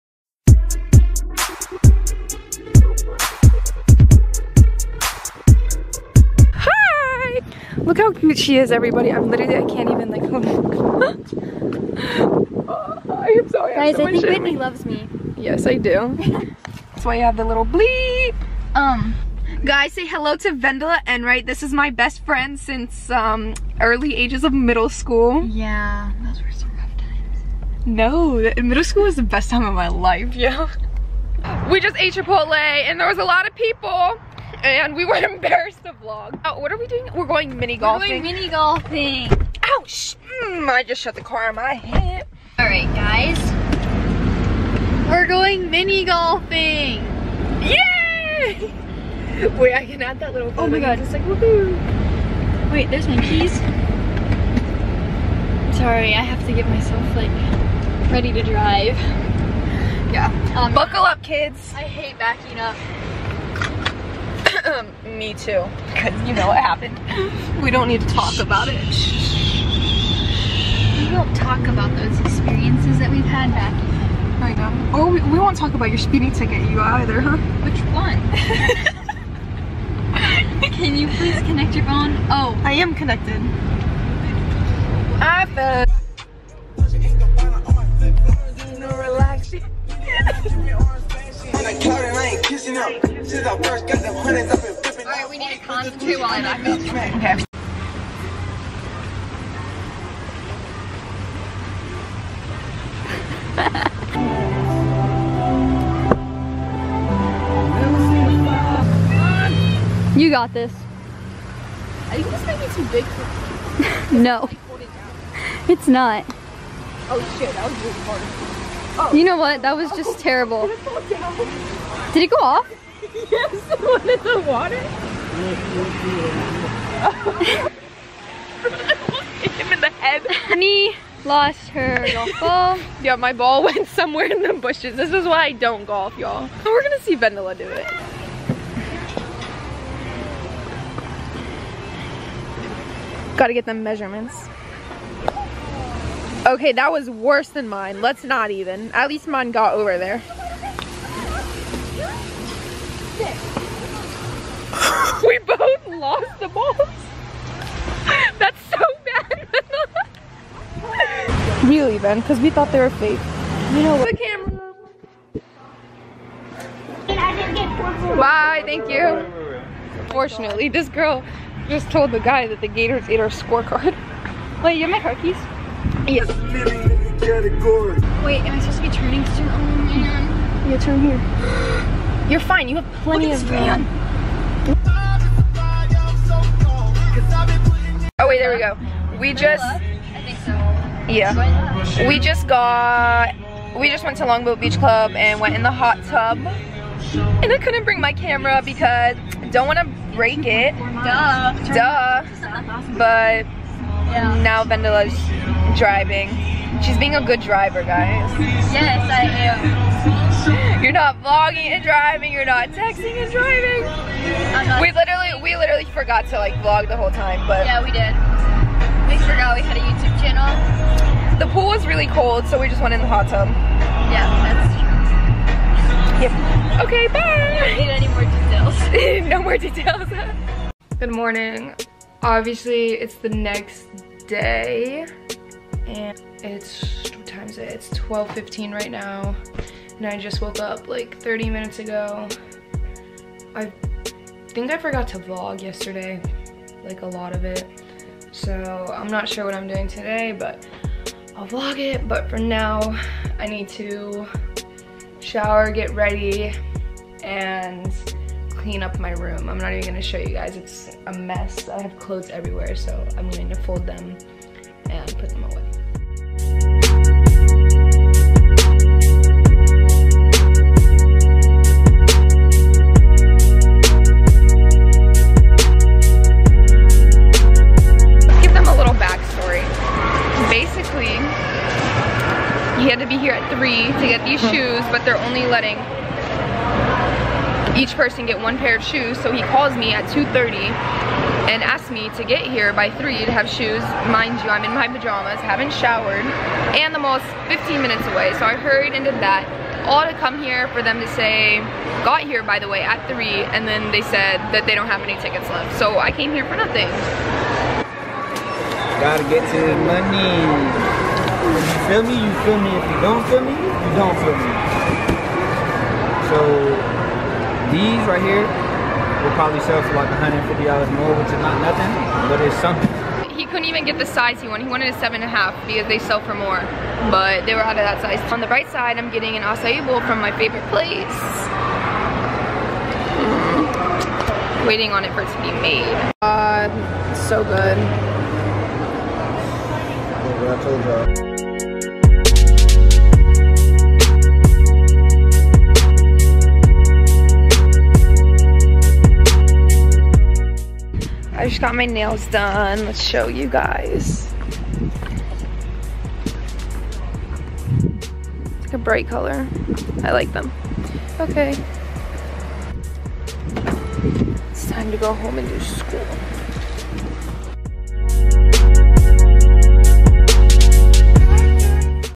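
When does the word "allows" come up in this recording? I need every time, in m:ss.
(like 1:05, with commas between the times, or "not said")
not said.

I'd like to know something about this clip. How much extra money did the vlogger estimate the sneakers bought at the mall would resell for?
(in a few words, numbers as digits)
$150.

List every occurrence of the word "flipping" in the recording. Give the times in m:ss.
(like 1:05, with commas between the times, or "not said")
1:34.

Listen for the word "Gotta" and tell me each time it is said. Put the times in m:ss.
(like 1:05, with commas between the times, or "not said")
2:23, 5:09.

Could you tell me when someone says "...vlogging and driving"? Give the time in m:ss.
3:31.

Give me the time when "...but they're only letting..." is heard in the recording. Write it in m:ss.
4:44.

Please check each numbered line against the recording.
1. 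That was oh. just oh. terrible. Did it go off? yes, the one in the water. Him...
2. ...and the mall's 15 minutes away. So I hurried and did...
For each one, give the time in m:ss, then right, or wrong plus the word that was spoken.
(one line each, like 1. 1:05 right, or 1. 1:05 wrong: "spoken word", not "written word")
1. 1:59 right
2. 4:56 right.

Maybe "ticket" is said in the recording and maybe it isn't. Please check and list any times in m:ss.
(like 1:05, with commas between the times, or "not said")
1:16, 5:05.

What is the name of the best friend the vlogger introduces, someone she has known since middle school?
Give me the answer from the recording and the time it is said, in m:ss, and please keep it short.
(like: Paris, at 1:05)
Vendela Enright, at 0:20.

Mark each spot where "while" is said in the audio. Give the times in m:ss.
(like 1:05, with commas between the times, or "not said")
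1:36.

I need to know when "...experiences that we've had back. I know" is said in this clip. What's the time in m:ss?
1:12.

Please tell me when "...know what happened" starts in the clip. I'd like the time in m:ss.
1:06.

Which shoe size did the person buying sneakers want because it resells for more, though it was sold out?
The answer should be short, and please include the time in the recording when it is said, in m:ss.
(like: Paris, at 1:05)
7.5, at 5:24.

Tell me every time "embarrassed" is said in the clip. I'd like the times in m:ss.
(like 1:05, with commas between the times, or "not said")
0:35.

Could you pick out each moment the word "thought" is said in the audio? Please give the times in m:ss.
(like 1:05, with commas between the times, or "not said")
2:42.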